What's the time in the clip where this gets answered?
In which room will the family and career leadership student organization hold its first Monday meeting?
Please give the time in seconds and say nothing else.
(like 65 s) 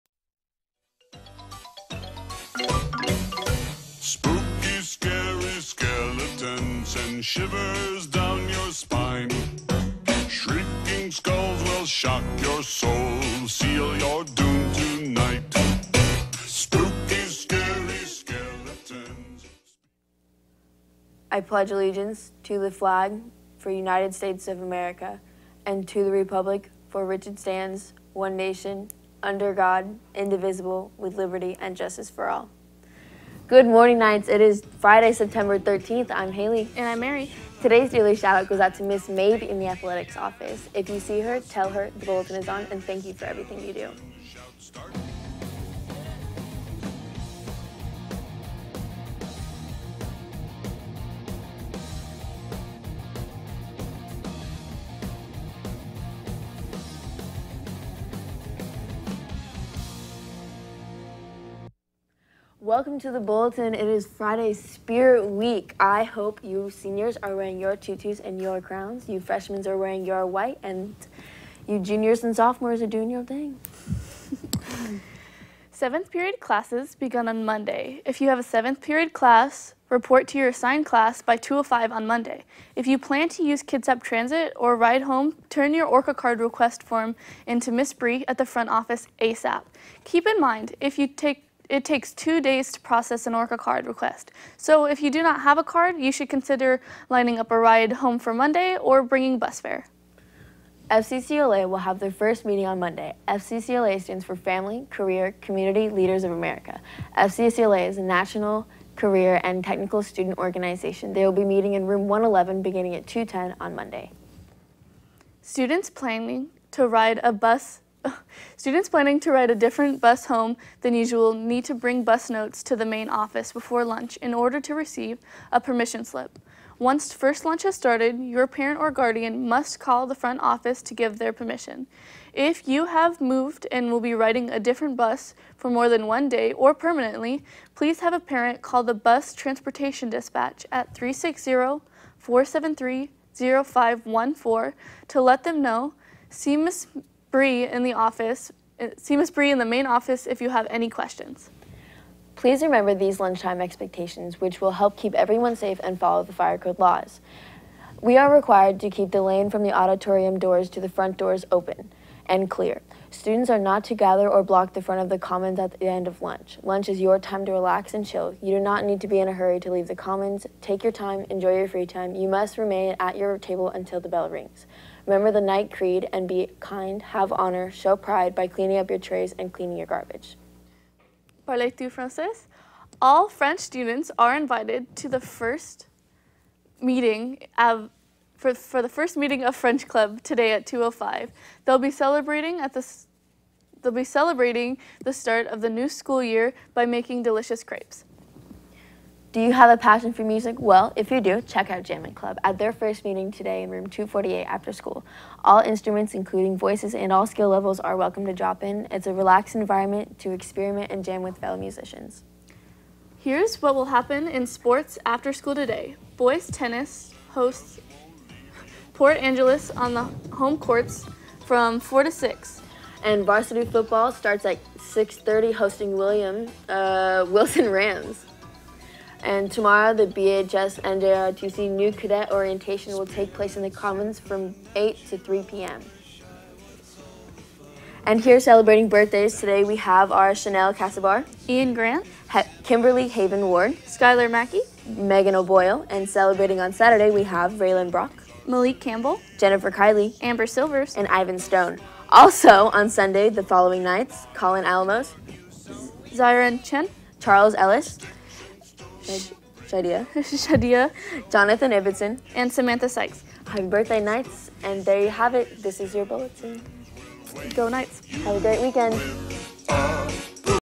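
111 s.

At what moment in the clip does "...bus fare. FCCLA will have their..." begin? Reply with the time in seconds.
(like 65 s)
99 s.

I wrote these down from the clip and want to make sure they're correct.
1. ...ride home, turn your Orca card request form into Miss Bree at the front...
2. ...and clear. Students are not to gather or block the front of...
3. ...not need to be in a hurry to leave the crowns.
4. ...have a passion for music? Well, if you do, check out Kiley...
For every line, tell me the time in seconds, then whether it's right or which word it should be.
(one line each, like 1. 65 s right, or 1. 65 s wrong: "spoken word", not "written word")
1. 84 s right
2. 162 s right
3. 168 s wrong: "commons", not "crowns"
4. 199 s wrong: "Jamming", not "Kiley".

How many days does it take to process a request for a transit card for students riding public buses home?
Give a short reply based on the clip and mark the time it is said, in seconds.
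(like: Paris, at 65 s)
2 days, at 92 s.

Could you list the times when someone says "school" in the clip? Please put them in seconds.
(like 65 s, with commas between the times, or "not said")
195 s, 204 s, 215 s.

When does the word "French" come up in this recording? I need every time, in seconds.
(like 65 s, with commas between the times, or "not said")
183 s, 189 s.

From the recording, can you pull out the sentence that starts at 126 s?
Once first lunch has started, your parent or guardian must call the front office to give their permission.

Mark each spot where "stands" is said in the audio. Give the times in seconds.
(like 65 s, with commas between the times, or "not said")
27 s, 104 s.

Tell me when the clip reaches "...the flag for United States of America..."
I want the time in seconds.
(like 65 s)
22 s.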